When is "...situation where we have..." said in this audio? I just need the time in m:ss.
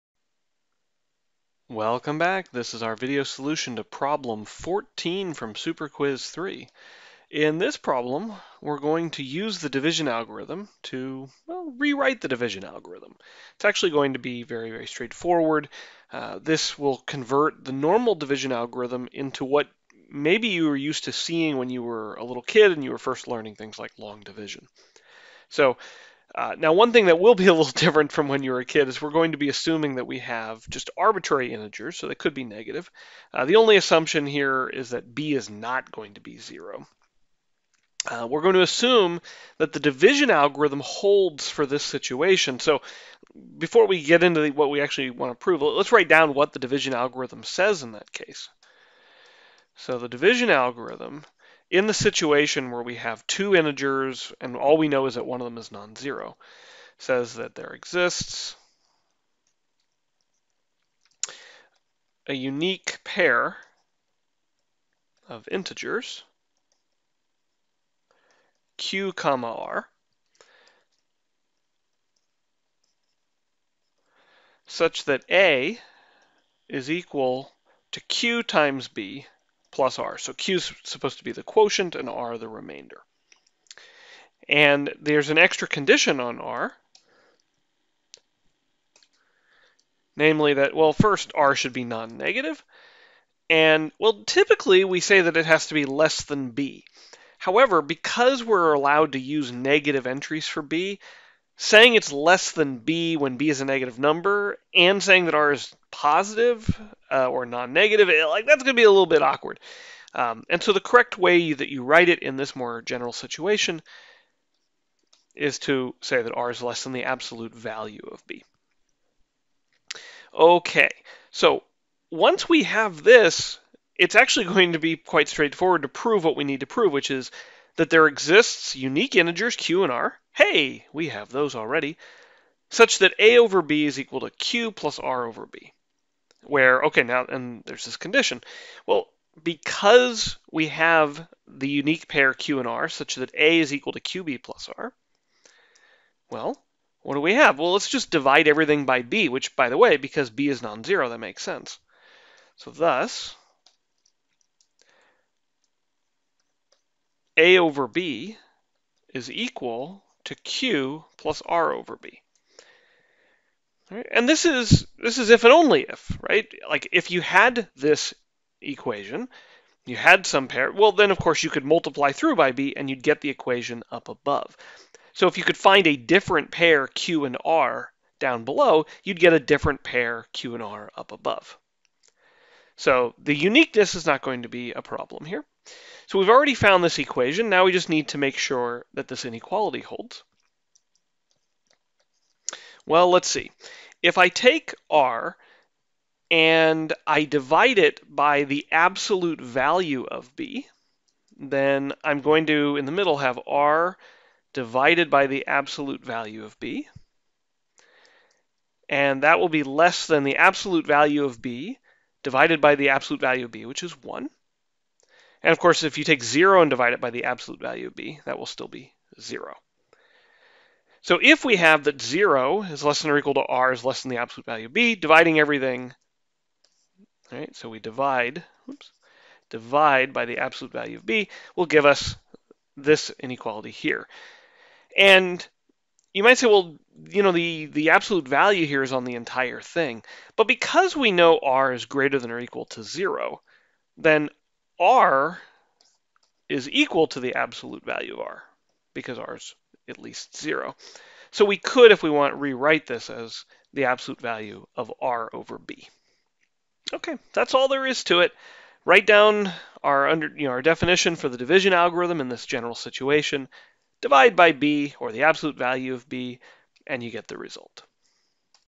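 0:51.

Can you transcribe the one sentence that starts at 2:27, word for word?
Well, let's just divide everything by b, which, by the way, because b is non-zero, that makes sense.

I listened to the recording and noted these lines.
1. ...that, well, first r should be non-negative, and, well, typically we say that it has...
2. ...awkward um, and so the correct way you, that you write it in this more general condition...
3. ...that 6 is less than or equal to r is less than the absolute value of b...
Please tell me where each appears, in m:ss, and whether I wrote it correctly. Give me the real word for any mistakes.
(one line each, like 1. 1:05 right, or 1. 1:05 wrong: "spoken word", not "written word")
1. 1:30 right
2. 1:49 wrong: "situation", not "condition"
3. 3:41 wrong: "0", not "6".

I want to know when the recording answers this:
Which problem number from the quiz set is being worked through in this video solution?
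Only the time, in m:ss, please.
0:03.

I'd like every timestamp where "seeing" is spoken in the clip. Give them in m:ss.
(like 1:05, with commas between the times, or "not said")
0:21.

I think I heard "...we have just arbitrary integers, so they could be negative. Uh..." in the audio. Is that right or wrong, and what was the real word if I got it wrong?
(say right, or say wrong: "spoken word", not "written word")
right.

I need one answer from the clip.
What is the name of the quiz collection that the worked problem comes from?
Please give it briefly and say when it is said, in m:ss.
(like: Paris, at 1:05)
Super Quiz 3, at 0:05.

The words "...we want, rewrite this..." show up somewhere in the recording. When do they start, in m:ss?
4:12.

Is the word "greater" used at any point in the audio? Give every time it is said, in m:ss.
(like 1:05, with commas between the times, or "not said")
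4:01.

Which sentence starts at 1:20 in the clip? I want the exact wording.
So q is supposed to be the quotient and r the remainder.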